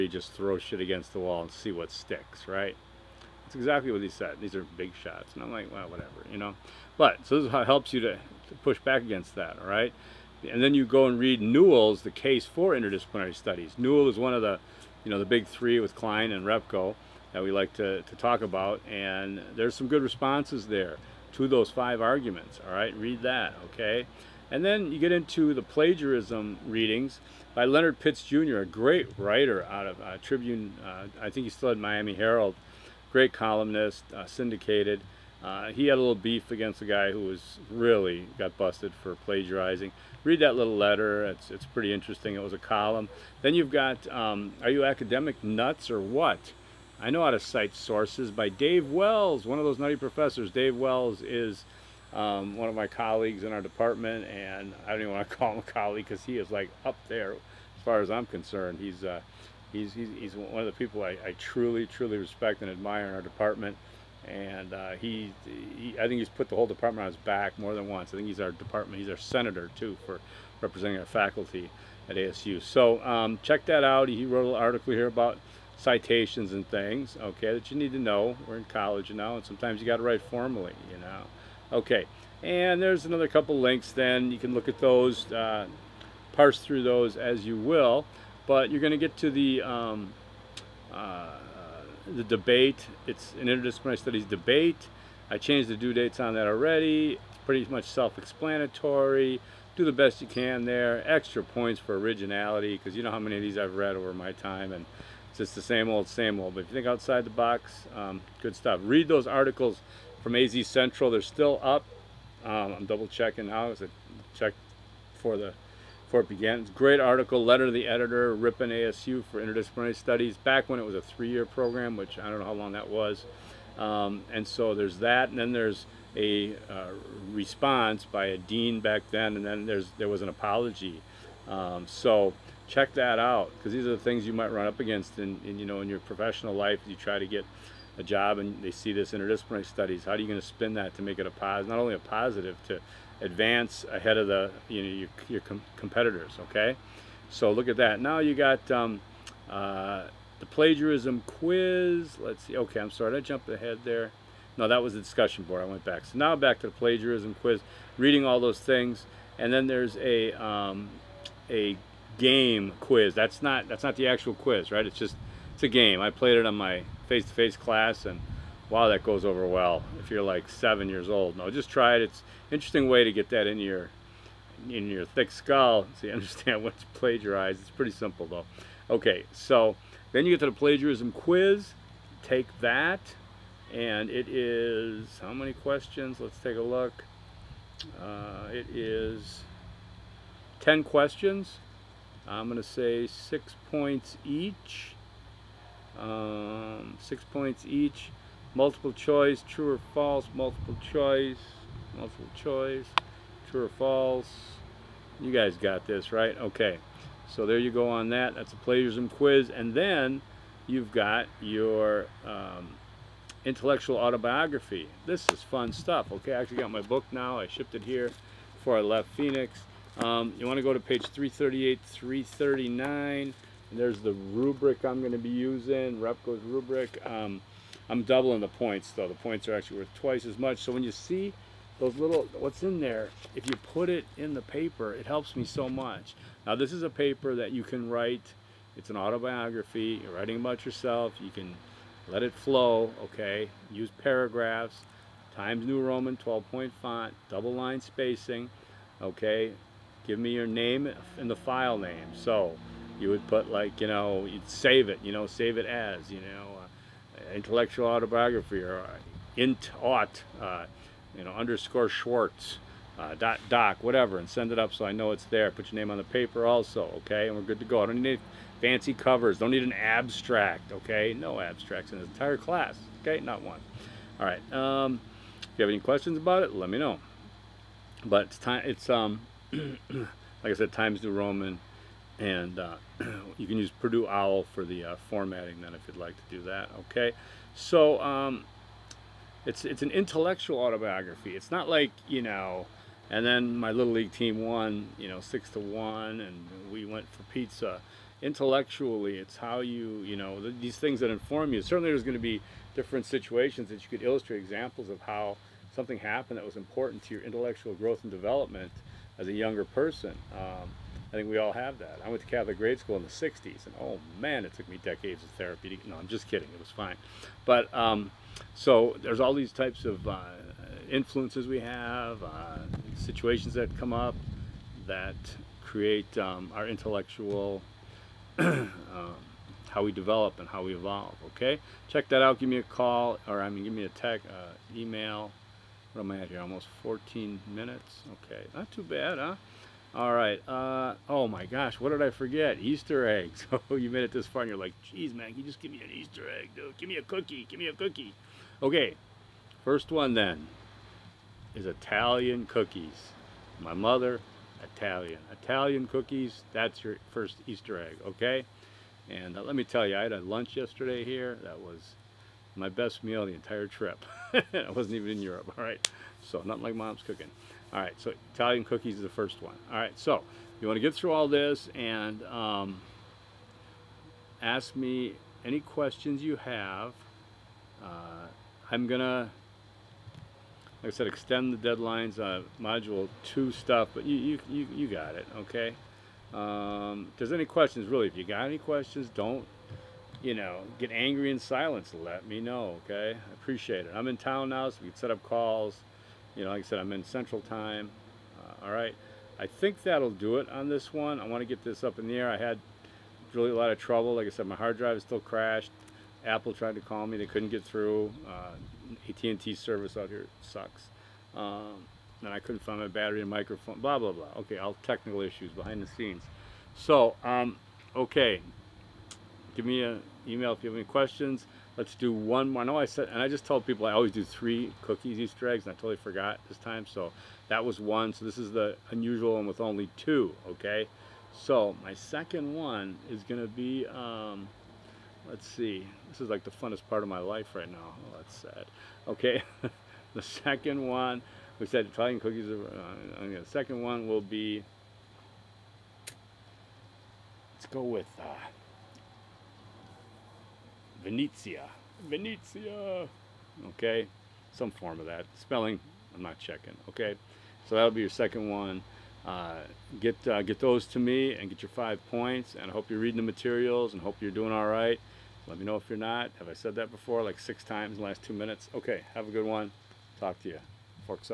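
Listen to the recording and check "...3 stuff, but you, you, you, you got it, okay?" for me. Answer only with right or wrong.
wrong.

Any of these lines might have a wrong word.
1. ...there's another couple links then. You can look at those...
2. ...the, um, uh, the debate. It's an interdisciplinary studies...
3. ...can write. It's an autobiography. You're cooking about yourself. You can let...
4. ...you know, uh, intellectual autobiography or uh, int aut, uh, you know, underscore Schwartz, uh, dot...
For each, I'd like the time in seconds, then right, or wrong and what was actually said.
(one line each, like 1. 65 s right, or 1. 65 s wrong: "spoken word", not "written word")
1. 82 s right
2. 89 s right
3. 237 s wrong: "writing", not "cooking"
4. 256 s right.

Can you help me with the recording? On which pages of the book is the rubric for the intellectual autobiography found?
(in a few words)
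338-339.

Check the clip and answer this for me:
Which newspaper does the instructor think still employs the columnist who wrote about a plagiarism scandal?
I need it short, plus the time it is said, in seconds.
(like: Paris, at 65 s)
Miami Herald, at 31 s.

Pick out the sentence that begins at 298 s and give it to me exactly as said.
Intellectually, it's how you you know th these things that inform you.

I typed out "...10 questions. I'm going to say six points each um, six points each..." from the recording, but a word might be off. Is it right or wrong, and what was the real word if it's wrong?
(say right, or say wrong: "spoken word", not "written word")
right.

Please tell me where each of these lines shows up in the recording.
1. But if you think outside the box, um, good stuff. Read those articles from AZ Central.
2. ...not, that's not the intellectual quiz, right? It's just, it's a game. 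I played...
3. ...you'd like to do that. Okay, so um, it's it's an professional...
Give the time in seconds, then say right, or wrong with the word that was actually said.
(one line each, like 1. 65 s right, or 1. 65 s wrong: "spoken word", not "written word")
1. 106 s right
2. 163 s wrong: "actual", not "intellectual"
3. 285 s wrong: "intellectual", not "professional".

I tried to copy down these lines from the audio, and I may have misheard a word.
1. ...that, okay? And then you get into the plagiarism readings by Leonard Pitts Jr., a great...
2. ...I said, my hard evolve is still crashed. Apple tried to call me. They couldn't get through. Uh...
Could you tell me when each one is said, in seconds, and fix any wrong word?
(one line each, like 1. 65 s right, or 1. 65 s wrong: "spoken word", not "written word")
1. 23 s right
2. 404 s wrong: "drive", not "evolve".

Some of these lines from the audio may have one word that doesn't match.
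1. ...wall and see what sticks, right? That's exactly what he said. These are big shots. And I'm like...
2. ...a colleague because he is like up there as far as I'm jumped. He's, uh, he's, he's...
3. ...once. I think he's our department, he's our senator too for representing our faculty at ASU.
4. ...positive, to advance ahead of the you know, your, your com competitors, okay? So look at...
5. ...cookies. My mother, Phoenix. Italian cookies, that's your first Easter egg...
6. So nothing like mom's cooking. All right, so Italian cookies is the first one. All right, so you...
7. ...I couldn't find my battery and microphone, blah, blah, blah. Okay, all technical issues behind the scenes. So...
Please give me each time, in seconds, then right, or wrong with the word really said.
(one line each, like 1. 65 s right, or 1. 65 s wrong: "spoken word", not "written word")
1. 1 s right
2. 55 s wrong: "concerned", not "jumped"
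3. 67 s right
4. 141 s right
5. 352 s wrong: "Italian", not "Phoenix"
6. 366 s right
7. 412 s right.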